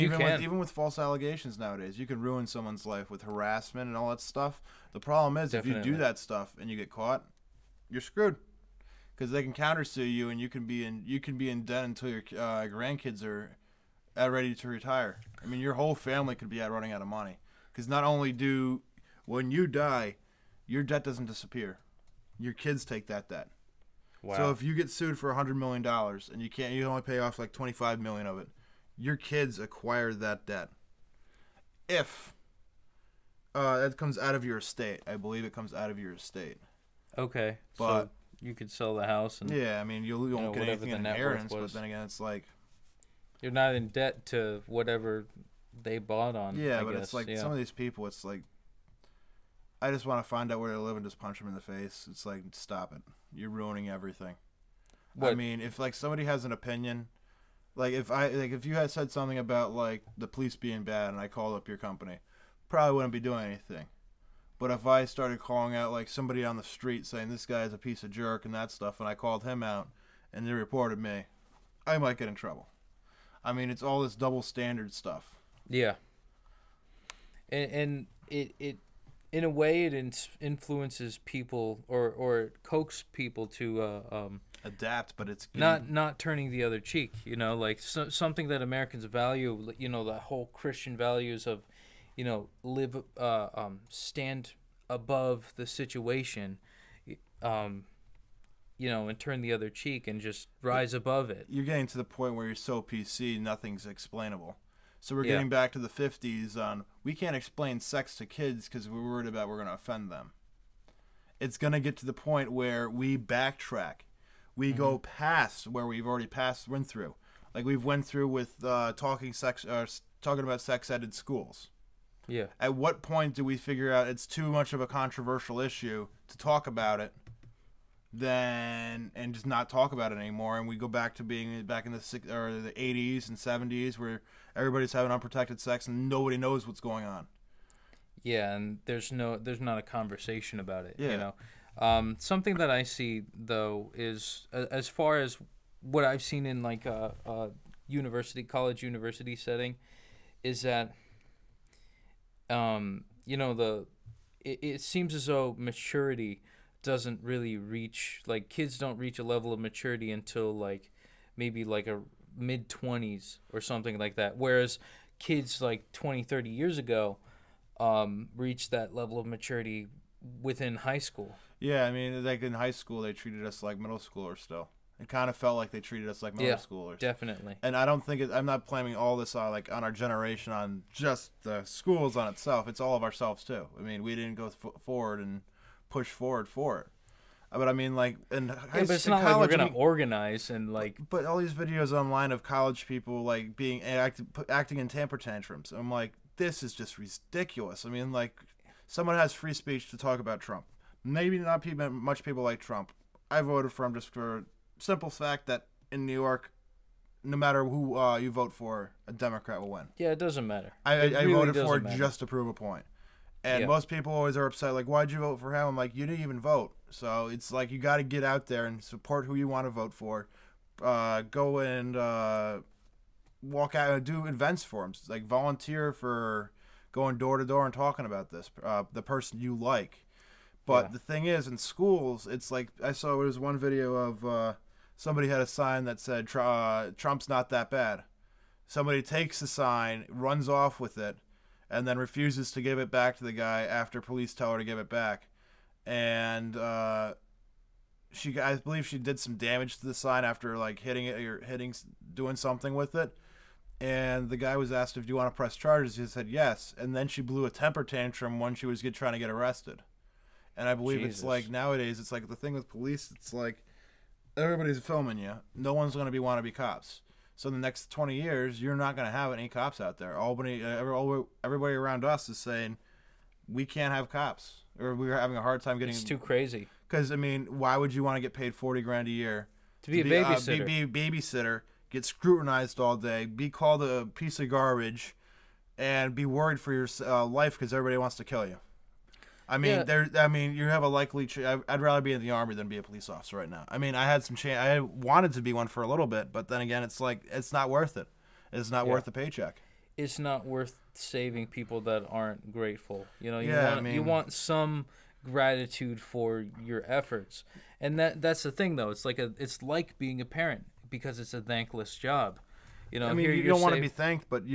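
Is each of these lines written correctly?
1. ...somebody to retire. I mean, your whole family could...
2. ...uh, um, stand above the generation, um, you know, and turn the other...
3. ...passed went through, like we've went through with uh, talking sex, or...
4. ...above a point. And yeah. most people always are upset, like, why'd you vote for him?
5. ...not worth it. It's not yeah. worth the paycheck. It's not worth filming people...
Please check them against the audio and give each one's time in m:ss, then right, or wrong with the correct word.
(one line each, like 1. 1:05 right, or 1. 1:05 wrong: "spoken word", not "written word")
1. 0:14 wrong: "ready", not "somebody"
2. 1:33 wrong: "situation", not "generation"
3. 1:56 right
4. 3:32 wrong: "prove", not "above"
5. 4:57 wrong: "saving", not "filming".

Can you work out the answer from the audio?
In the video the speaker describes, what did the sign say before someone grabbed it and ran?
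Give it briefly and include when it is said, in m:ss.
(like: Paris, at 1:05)
Trump's not that bad, at 3:56.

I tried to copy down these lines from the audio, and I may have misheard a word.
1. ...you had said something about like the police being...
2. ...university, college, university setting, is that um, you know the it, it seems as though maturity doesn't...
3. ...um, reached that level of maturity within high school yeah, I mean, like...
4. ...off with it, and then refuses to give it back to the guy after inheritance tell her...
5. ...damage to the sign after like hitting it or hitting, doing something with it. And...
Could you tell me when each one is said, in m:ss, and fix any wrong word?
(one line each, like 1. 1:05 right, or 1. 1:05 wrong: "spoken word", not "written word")
1. 0:58 right
2. 2:27 right
3. 2:47 right
4. 4:00 wrong: "police", not "inheritance"
5. 4:09 right.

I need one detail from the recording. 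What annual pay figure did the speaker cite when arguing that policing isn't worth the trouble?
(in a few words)
$40,000.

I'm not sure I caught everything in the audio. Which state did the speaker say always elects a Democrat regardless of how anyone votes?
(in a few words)
New York.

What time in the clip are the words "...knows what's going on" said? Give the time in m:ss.
2:16.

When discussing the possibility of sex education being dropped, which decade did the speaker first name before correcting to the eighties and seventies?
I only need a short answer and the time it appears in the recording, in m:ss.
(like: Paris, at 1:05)
the 60s, at 2:11.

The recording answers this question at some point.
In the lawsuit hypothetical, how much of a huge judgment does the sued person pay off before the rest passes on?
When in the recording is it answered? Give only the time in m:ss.
0:27.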